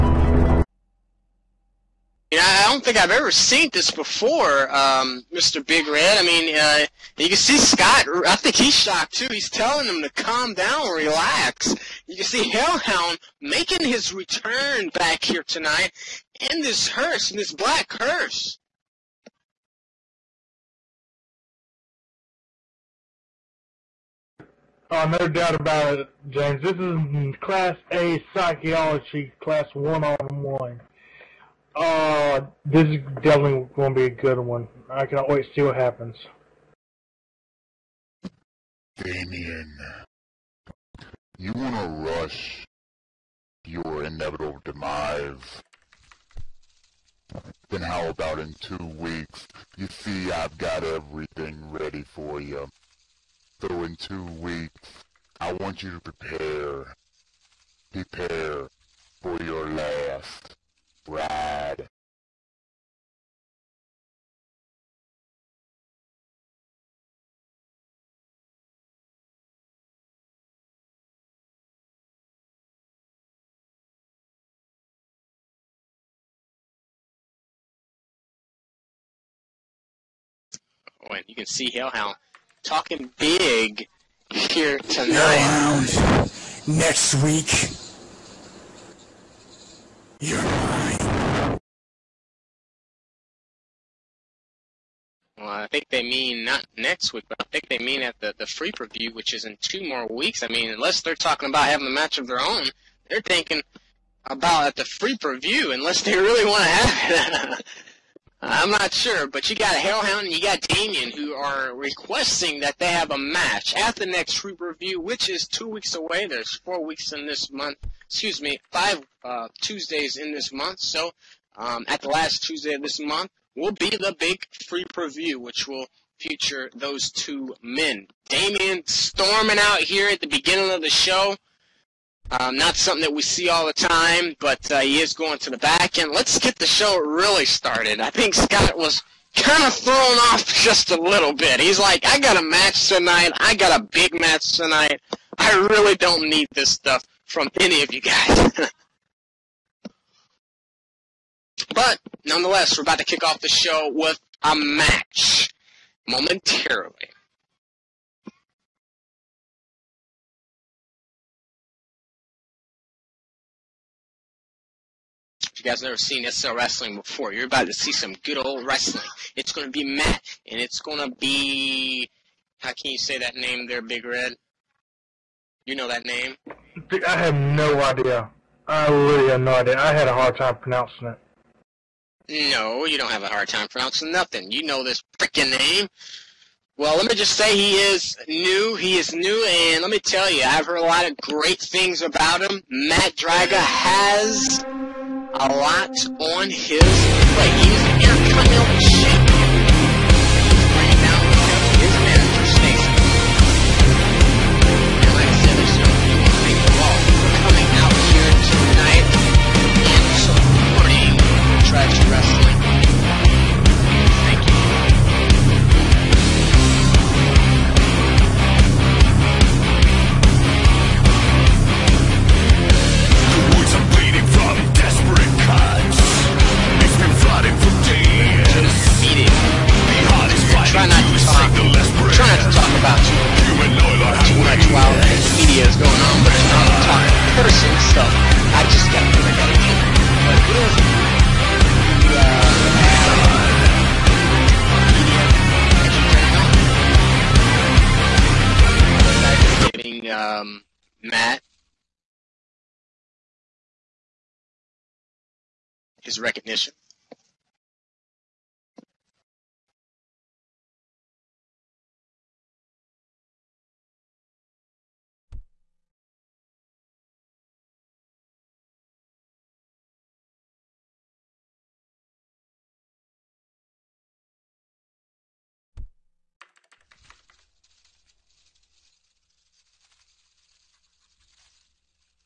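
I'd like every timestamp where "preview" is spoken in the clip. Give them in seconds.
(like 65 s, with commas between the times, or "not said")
98 s, 105 s, 124 s.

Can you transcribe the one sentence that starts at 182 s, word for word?
No, you don't have a hard time pronouncing nothing.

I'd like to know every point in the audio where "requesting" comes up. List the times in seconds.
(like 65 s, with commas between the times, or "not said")
111 s.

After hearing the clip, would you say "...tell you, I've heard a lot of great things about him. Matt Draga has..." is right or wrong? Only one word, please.
right.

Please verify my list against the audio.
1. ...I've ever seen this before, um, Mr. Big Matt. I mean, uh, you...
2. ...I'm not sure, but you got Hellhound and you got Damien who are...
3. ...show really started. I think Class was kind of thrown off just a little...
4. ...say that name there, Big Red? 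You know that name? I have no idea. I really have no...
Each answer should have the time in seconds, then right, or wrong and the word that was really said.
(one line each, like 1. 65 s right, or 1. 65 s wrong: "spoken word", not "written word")
1. 2 s wrong: "Red", not "Matt"
2. 108 s right
3. 136 s wrong: "Scott", not "Class"
4. 172 s right.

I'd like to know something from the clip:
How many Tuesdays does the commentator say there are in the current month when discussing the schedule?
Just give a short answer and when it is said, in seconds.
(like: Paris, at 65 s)
5, at 118 s.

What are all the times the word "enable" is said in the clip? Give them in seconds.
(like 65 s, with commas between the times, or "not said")
not said.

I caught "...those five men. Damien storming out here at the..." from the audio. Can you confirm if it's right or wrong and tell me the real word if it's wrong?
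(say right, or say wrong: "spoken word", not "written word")
wrong: "two", not "five".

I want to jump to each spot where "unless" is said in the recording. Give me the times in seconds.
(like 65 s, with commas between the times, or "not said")
100 s, 105 s.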